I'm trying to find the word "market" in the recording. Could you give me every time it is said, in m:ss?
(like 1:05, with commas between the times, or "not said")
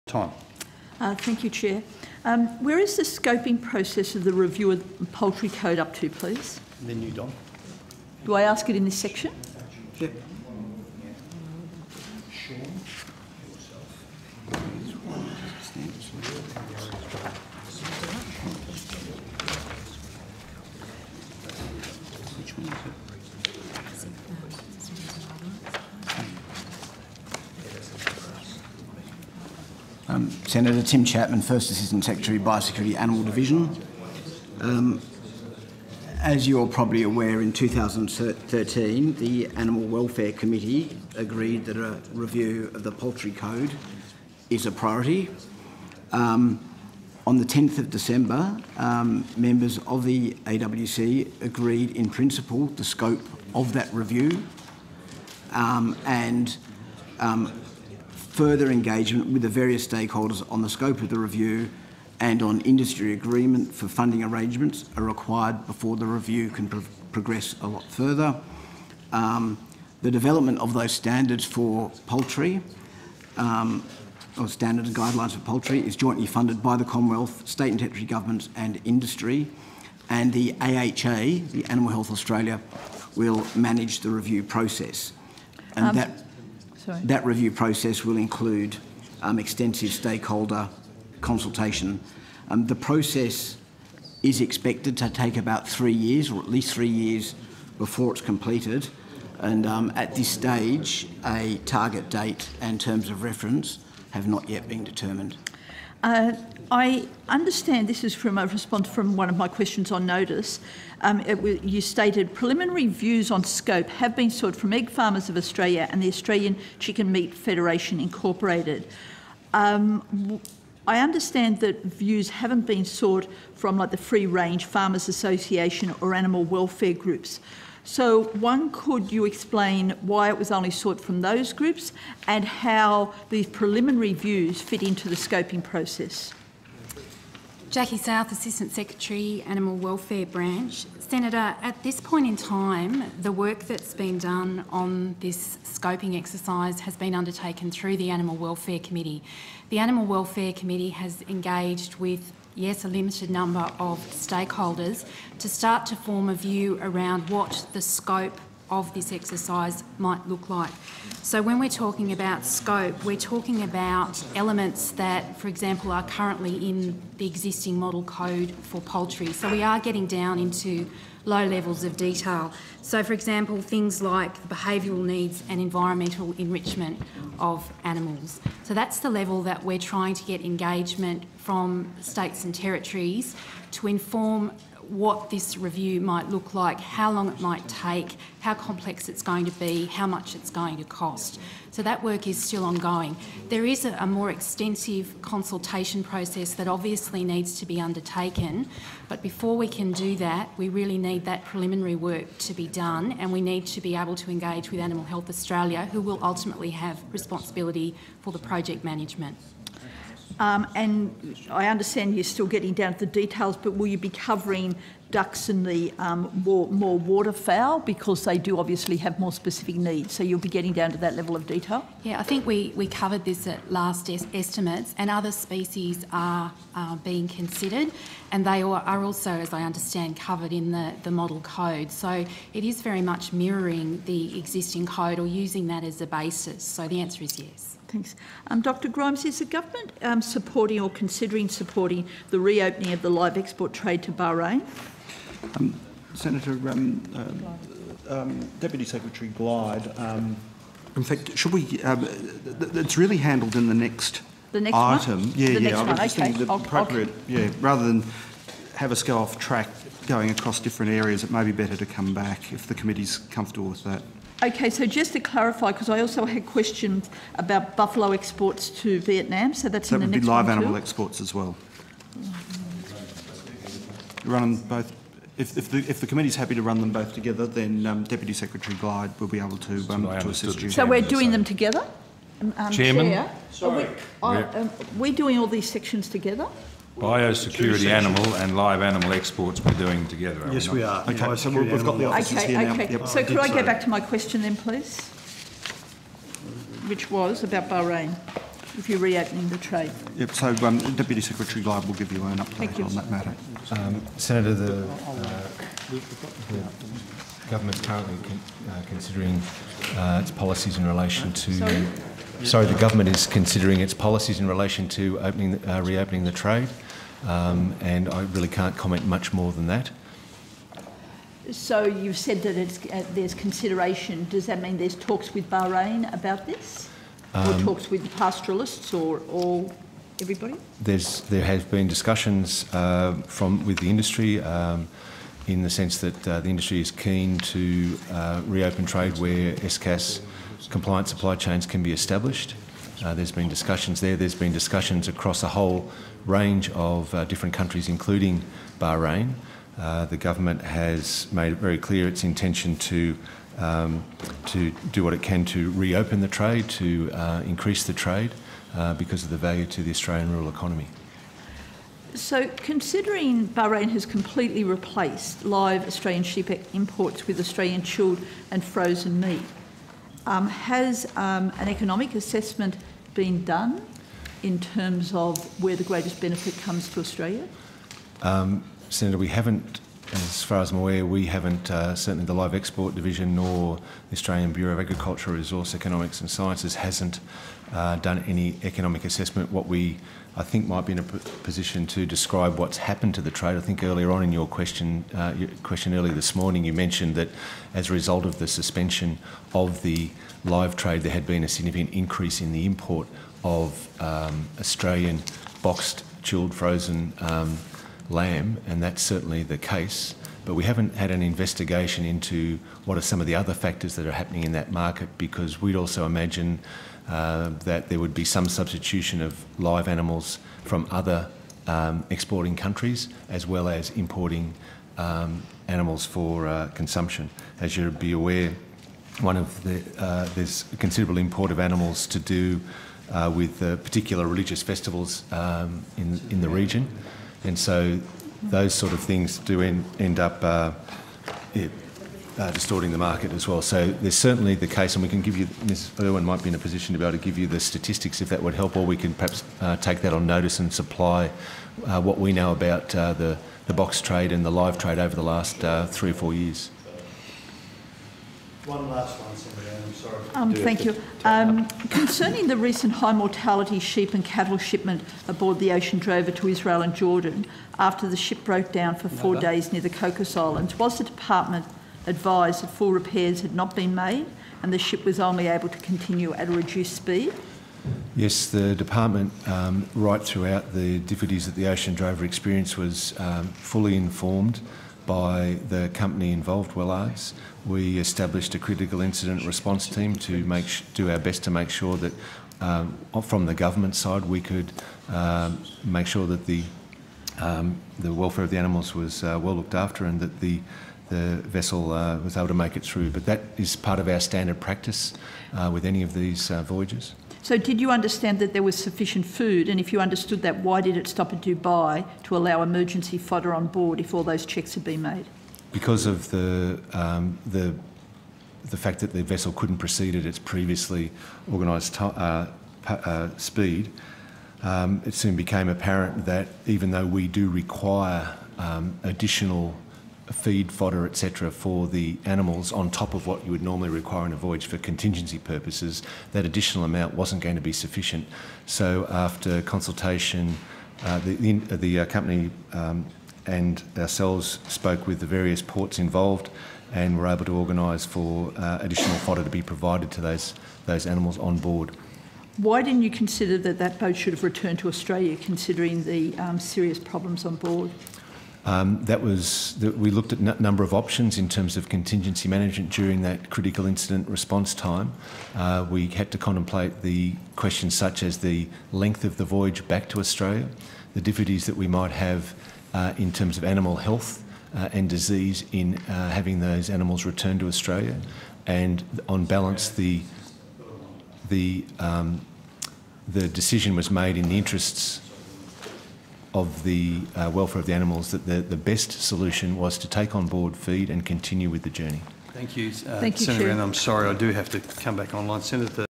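6:54, 7:22.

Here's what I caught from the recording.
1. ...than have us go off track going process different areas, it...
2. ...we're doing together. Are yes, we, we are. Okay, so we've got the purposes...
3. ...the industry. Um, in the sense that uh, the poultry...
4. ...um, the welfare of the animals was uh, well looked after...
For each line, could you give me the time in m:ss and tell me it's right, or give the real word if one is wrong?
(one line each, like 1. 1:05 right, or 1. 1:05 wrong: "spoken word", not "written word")
1. 4:17 wrong: "across", not "process"
2. 4:49 wrong: "offices", not "purposes"
3. 5:33 wrong: "industry", not "poultry"
4. 8:17 right.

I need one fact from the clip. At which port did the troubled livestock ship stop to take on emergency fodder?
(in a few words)
Dubai.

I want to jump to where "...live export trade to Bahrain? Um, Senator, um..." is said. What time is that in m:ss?
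4:03.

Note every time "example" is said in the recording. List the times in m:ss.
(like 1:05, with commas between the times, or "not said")
2:45, 2:53.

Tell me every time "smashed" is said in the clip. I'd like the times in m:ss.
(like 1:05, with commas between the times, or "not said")
not said.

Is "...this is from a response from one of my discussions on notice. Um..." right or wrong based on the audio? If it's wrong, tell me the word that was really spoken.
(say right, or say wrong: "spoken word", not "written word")
wrong: "questions", not "discussions".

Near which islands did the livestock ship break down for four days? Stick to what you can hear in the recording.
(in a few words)
Cocos Islands.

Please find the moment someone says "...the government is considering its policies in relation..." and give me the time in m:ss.
5:12.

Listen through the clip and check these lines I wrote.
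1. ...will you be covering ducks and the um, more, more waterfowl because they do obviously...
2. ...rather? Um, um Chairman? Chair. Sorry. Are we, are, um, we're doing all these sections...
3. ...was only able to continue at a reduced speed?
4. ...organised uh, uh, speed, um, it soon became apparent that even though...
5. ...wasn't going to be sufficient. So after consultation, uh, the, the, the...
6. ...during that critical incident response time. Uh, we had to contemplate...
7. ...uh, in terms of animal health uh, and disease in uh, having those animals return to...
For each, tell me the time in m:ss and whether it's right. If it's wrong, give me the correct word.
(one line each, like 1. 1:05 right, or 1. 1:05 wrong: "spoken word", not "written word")
1. 3:33 right
2. 4:41 wrong: "together", not "rather"
3. 7:55 right
4. 8:41 right
5. 8:57 right
6. 9:22 right
7. 9:32 right.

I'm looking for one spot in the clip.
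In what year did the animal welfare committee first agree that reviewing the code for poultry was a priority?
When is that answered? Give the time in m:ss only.
0:37.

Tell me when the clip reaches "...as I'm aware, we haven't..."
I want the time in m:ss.
6:20.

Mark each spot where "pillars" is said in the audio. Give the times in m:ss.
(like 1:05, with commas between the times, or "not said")
not said.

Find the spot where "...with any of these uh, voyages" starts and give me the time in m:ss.
8:25.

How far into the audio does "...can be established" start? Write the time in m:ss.
5:41.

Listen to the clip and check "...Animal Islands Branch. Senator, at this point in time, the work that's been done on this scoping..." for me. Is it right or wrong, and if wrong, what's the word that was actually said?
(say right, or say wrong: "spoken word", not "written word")
wrong: "Welfare", not "Islands".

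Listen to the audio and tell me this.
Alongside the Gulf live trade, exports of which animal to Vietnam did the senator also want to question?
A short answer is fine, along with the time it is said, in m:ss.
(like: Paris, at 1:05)
Buffalo, at 4:27.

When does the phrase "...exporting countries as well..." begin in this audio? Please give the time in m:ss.
7:02.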